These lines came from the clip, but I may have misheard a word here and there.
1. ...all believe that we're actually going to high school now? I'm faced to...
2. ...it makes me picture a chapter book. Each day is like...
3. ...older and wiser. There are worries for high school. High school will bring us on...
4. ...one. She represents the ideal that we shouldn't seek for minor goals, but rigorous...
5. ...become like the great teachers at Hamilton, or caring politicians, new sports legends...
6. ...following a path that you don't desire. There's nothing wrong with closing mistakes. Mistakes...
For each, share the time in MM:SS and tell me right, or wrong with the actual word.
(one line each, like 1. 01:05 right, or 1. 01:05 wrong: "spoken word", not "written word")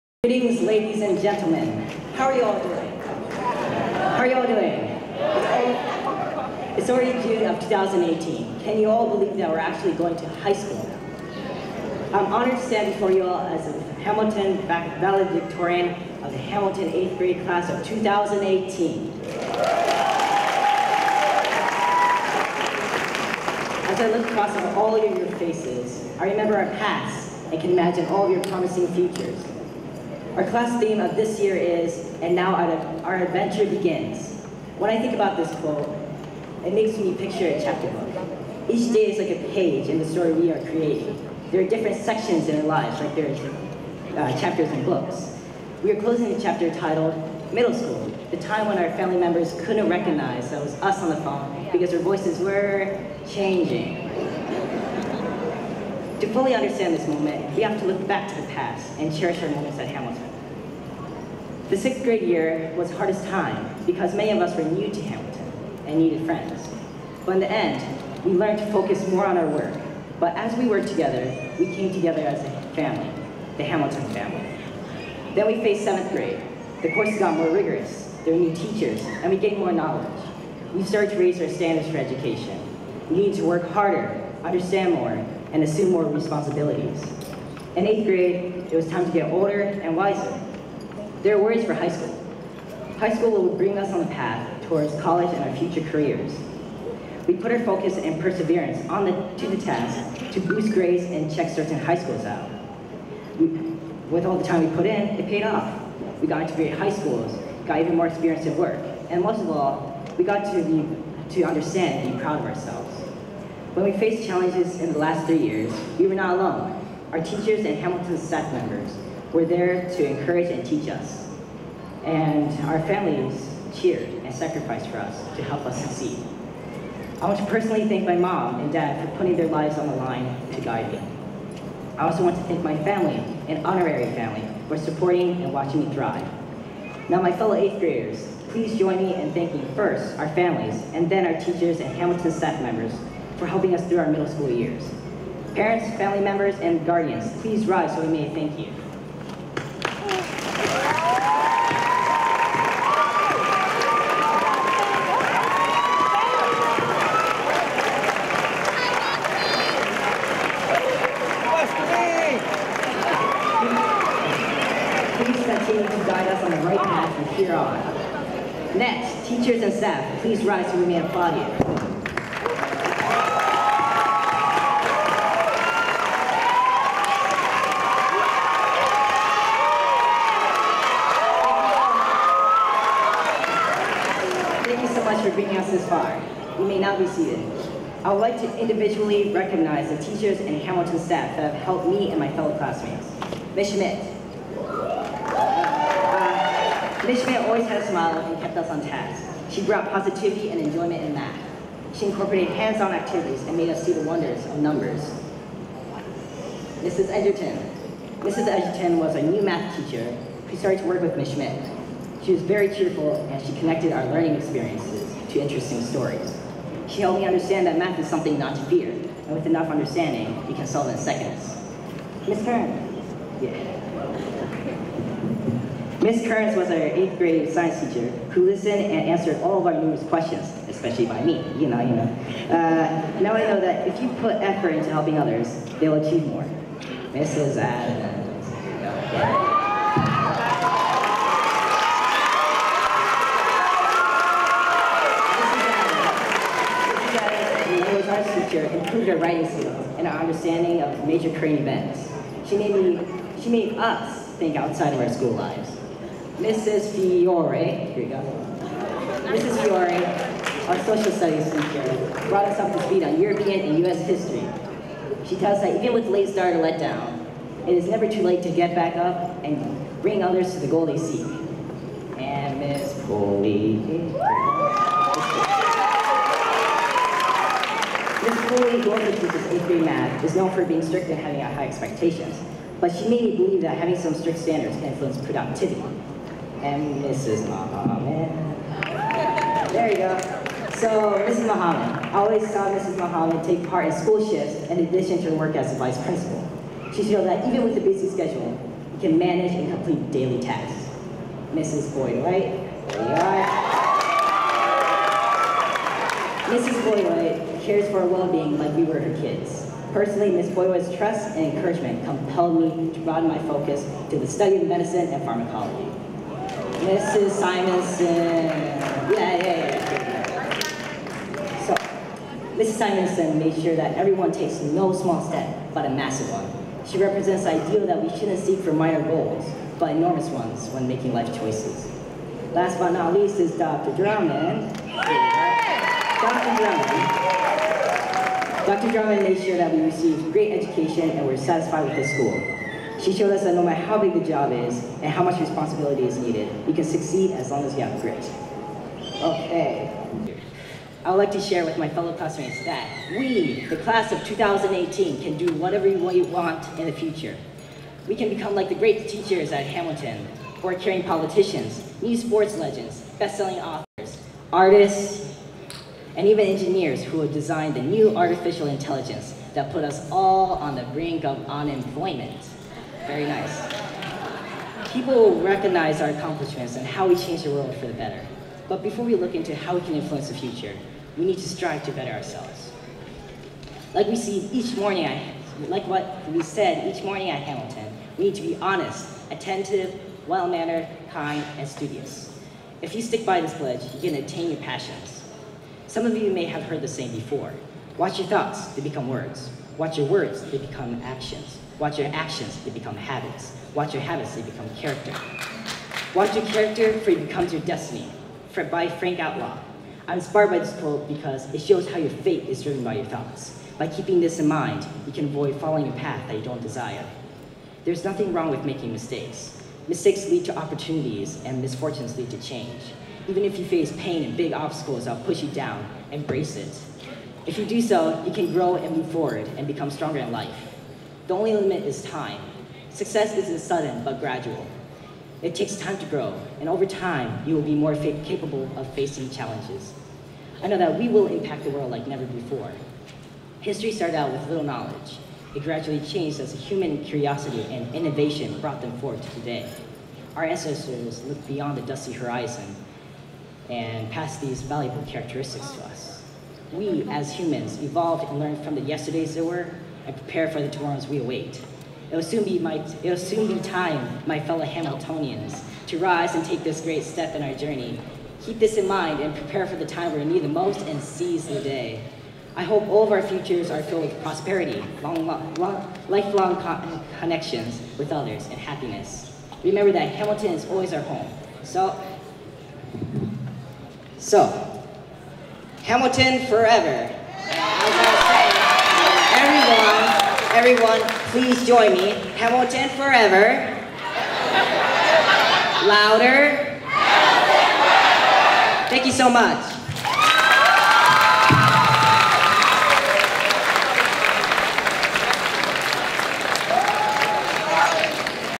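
1. 00:08 wrong: "honored", not "faced"
2. 00:36 right
3. 01:29 right
4. 05:26 wrong: "enormous", not "rigorous"
5. 05:58 right
6. 06:55 wrong: "making", not "closing".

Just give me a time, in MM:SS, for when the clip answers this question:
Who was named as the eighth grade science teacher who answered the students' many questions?
03:46.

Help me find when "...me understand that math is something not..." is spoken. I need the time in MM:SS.
03:37.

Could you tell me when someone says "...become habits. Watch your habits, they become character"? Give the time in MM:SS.
06:42.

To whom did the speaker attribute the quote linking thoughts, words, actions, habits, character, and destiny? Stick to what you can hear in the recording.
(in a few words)
Frank Outlaw.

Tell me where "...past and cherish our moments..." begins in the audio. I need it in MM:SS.
00:58.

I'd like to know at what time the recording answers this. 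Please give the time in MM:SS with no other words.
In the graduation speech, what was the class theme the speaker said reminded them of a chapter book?
00:32.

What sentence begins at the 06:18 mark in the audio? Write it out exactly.
But before we look into how we can influence the future, we need to strive to better ourselves.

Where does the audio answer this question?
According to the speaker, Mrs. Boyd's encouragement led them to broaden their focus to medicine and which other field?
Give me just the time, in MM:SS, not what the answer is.
05:15.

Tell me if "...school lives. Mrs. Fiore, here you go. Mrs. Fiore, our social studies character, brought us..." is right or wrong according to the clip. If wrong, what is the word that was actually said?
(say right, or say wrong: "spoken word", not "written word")
wrong: "teacher", not "character".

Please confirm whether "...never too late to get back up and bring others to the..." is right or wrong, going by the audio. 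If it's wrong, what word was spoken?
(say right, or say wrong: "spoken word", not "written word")
right.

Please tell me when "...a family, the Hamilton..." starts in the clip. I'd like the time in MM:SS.
01:12.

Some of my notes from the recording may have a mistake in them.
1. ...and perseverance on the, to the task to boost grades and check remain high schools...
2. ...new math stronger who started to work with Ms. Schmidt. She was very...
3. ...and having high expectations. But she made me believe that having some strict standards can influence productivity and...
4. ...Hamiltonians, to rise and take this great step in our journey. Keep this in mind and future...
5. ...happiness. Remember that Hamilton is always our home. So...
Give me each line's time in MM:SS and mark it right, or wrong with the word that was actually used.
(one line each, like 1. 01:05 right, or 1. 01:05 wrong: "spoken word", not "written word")
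1. 01:37 wrong: "certain", not "remain"
2. 03:29 wrong: "teacher", not "stronger"
3. 04:41 right
4. 07:44 wrong: "prepare", not "future"
5. 07:58 right.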